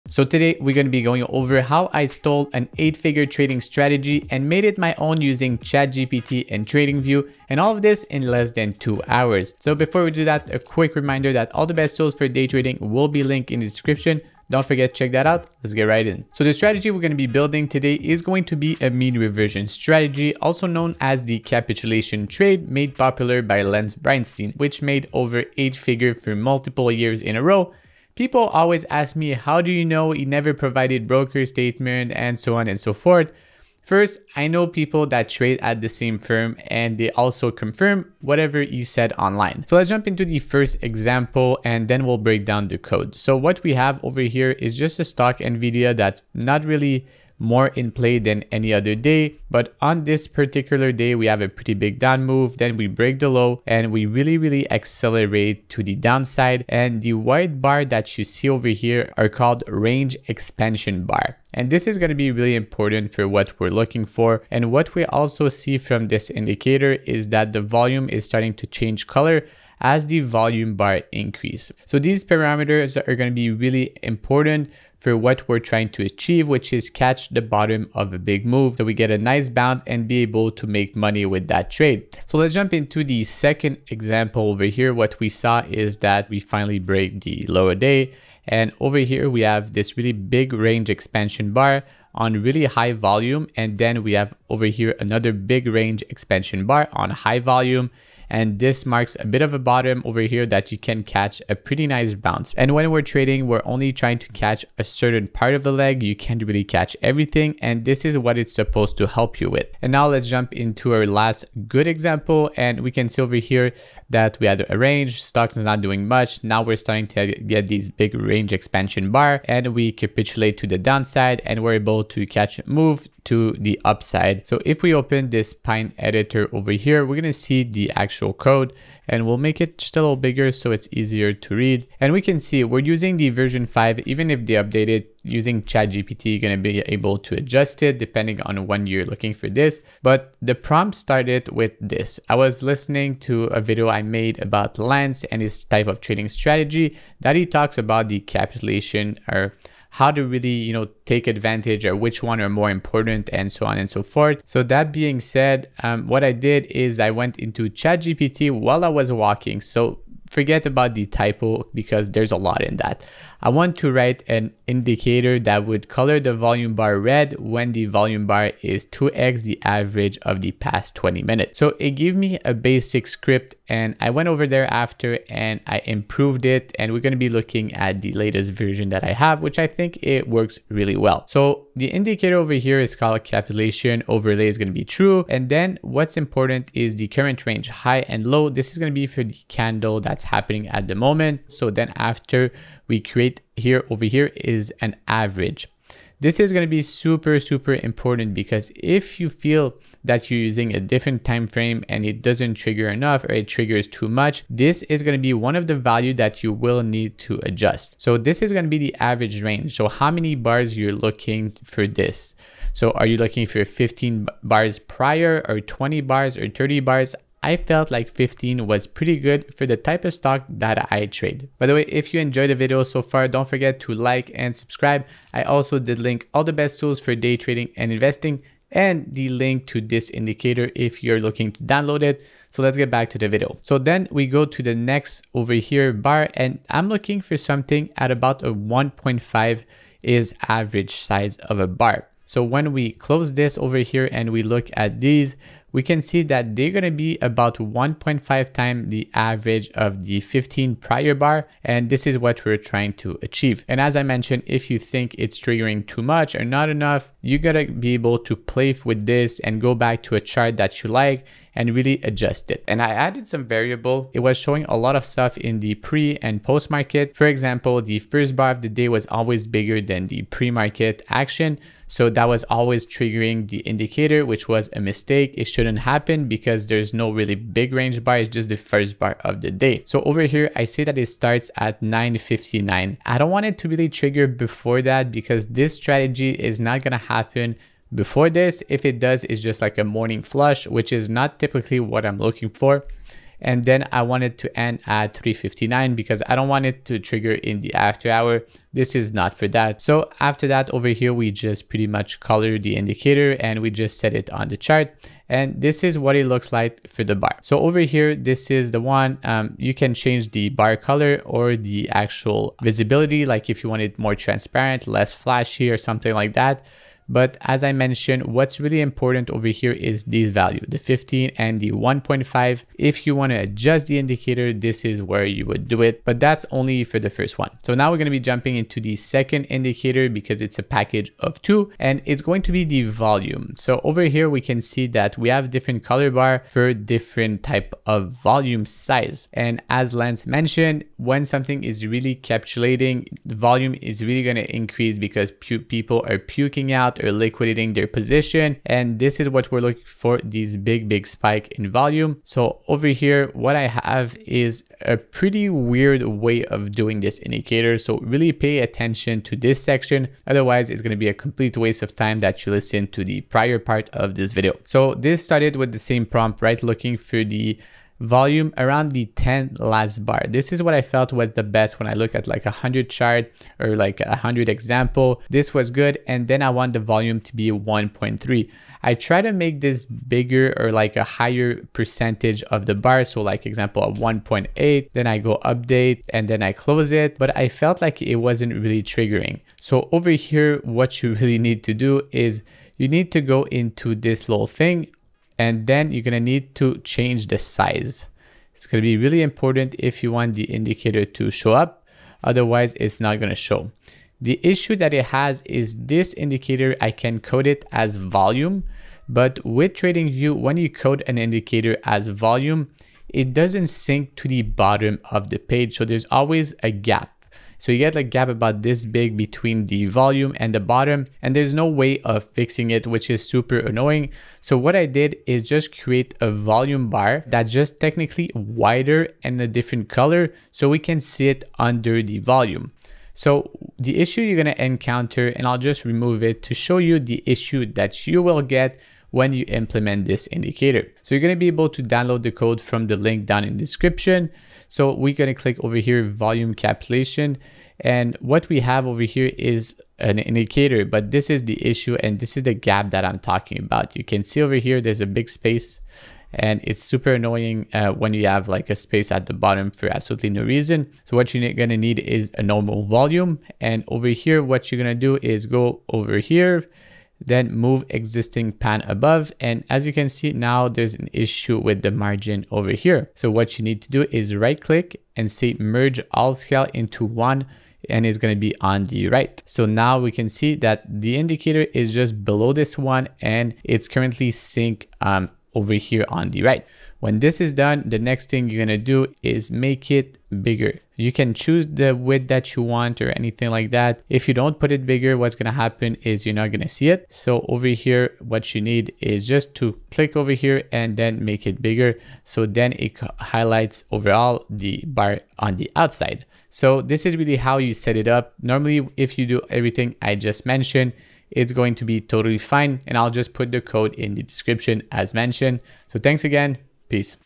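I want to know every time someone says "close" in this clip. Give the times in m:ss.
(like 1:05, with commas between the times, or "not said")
4:02, 6:26.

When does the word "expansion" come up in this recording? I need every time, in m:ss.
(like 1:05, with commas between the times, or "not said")
1:00, 1:30, 1:36, 1:58.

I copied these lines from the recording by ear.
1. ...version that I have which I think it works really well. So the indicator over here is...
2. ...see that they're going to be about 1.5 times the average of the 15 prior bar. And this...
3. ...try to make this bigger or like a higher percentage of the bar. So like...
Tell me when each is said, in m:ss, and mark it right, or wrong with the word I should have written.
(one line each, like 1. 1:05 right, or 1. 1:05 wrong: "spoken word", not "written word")
1. 2:58 right
2. 4:06 right
3. 6:18 right.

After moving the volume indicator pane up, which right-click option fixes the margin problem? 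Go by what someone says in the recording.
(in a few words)
merge all scale into one.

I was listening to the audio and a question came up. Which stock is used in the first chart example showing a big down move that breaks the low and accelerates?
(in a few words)
NVIDIA.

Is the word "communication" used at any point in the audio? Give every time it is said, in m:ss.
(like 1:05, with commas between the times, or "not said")
not said.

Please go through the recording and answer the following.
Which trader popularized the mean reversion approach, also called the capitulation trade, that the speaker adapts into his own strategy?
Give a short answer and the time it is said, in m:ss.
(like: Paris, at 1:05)
Lance Breitstein, at 0:23.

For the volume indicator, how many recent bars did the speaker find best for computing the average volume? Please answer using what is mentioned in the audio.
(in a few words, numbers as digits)
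10.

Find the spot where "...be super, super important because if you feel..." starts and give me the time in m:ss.
3:16.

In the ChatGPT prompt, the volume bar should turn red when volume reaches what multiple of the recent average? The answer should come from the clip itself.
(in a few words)
2x.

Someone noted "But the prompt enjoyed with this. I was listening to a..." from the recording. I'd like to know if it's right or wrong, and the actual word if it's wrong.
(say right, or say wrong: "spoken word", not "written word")
wrong: "started", not "enjoyed".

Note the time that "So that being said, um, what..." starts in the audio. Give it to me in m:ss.
2:34.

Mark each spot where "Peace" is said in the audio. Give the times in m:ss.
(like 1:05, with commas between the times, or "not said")
8:36.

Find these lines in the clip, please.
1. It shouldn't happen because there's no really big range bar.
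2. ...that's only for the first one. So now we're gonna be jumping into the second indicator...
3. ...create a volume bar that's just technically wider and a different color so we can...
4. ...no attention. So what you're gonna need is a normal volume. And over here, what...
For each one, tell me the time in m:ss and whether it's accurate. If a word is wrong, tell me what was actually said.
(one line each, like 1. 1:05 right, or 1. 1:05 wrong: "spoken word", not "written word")
1. 4:35 right
2. 5:26 right
3. 7:05 right
4. 7:40 wrong: "reason", not "attention".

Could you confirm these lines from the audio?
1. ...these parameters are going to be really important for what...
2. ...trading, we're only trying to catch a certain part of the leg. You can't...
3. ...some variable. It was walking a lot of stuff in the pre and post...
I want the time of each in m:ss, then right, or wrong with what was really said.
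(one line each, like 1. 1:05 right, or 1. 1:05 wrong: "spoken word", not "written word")
1. 1:11 right
2. 1:43 right
3. 4:23 wrong: "showing", not "walking".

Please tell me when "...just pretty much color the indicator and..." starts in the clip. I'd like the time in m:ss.
5:01.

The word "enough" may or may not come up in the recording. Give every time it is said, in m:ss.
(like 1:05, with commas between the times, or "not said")
3:22, 4:16.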